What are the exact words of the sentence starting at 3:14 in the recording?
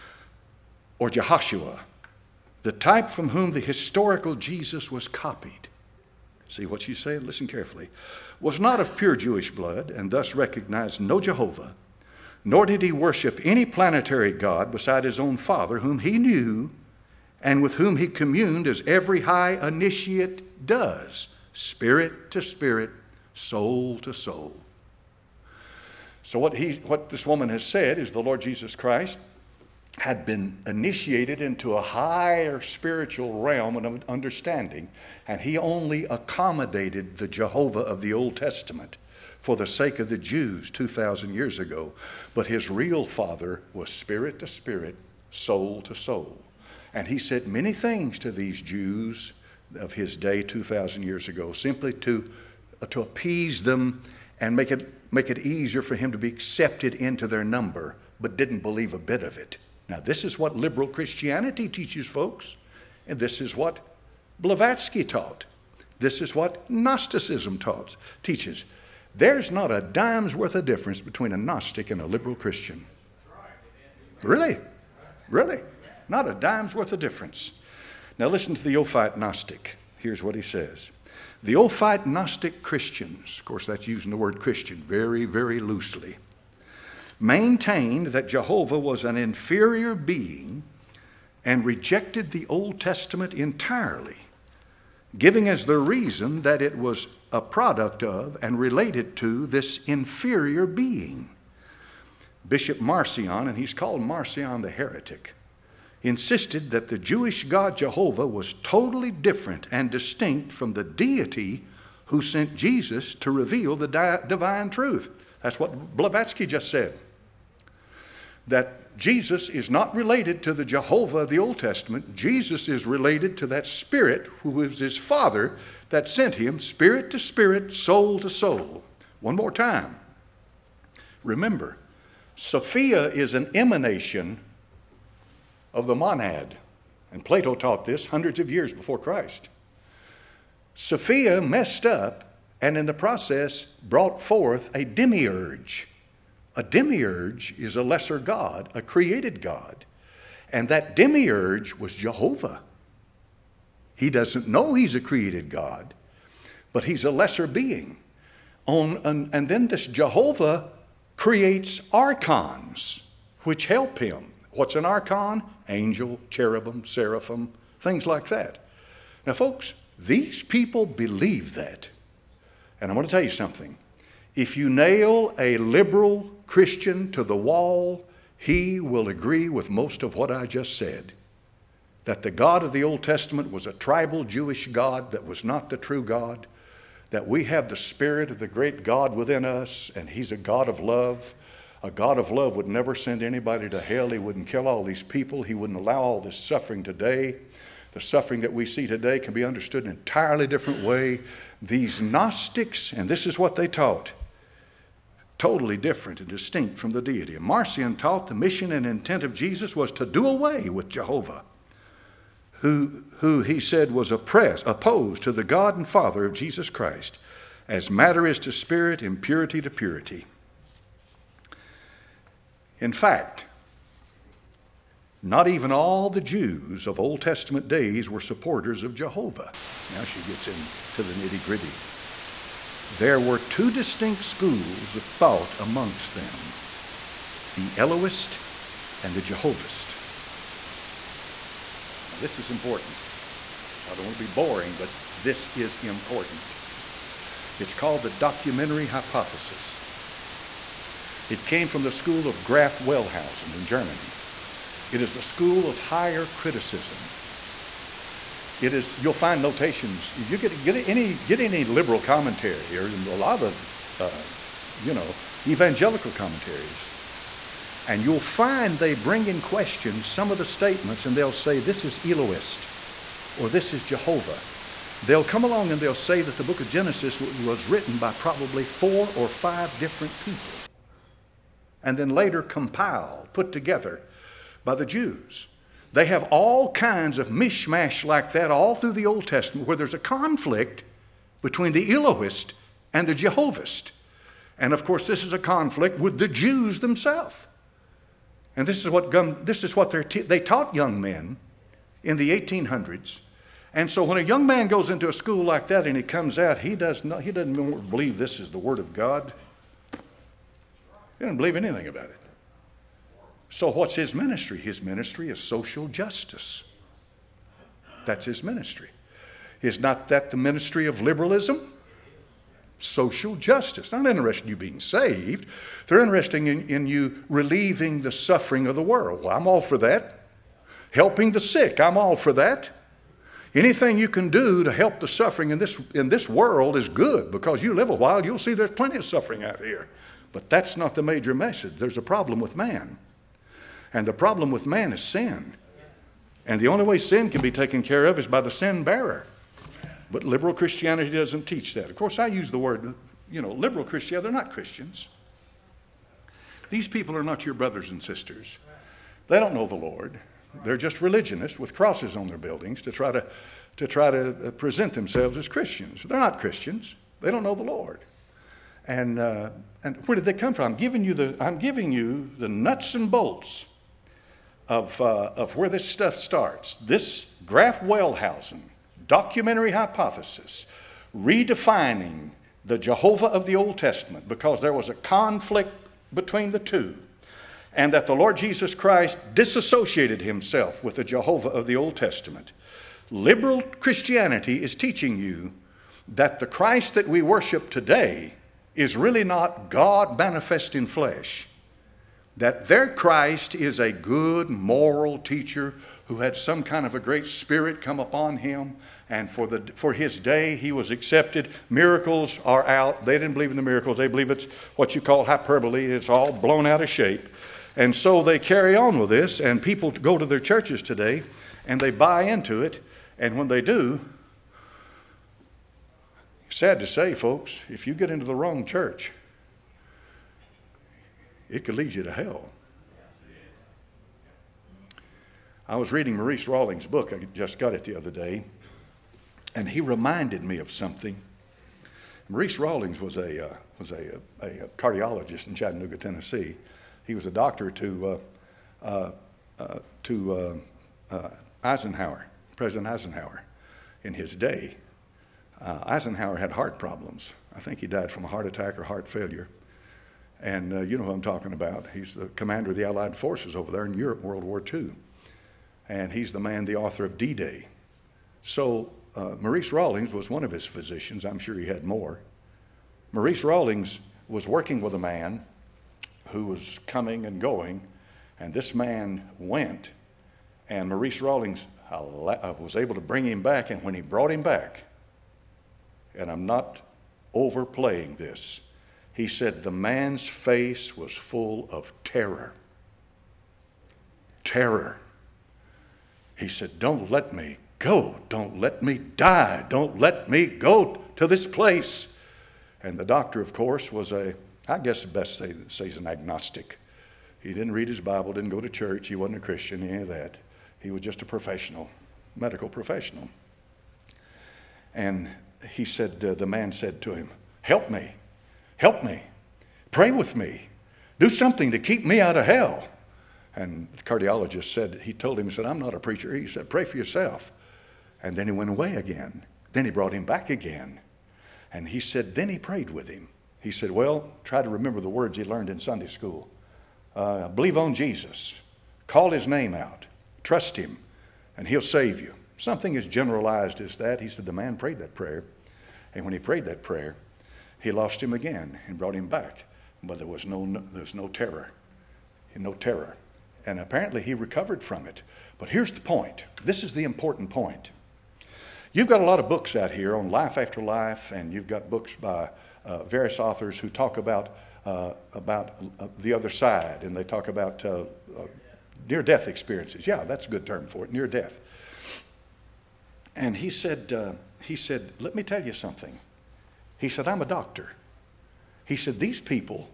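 He wouldn't kill all these people.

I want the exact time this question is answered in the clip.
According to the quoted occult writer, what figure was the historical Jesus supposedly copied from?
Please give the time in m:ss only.
0:01.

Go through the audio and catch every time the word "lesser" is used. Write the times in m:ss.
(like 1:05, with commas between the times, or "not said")
2:27, 2:37.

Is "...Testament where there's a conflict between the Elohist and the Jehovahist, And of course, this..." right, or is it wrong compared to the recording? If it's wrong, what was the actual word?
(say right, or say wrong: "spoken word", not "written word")
right.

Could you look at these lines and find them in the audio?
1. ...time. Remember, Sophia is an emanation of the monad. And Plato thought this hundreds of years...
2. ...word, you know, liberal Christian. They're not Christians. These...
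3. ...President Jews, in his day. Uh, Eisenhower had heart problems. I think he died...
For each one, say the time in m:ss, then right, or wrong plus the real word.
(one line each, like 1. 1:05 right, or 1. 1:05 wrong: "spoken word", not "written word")
1. 2:09 wrong: "taught", not "thought"
2. 5:52 right
3. 7:32 wrong: "Eisenhower", not "Jews".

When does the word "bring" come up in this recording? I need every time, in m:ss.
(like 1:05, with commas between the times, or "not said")
4:28, 8:03.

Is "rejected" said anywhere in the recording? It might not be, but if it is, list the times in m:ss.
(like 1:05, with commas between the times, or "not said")
1:31.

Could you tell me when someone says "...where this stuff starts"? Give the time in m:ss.
6:15.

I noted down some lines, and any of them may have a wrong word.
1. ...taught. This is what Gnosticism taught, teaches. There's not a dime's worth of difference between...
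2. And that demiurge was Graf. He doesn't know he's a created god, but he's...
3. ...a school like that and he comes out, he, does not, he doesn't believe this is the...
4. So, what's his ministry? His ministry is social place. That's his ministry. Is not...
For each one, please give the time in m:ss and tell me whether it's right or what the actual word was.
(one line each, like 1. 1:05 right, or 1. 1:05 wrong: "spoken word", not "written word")
1. 1:05 right
2. 2:30 wrong: "Jehovah", not "Graf"
3. 5:05 right
4. 5:13 wrong: "justice", not "place".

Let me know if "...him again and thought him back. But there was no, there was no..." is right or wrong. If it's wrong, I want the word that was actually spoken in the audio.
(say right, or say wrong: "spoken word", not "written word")
wrong: "brought", not "thought".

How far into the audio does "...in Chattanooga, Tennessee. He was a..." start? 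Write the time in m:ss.
7:25.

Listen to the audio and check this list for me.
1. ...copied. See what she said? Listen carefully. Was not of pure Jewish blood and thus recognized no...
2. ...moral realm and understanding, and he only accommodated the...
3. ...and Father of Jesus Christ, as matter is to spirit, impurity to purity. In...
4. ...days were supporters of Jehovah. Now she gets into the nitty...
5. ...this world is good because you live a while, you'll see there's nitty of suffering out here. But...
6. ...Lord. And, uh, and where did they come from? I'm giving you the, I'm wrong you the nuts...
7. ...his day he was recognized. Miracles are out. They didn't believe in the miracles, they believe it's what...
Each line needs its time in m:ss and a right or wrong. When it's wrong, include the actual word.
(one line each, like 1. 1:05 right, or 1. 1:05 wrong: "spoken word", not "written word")
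1. 0:05 right
2. 0:32 wrong: "spiritual", not "moral"
3. 3:35 right
4. 3:47 right
5. 5:36 wrong: "plenty", not "nitty"
6. 6:07 wrong: "giving", not "wrong"
7. 6:49 wrong: "accepted", not "recognized".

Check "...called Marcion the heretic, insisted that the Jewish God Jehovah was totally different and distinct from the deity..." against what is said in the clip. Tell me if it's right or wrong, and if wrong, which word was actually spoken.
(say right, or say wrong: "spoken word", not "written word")
right.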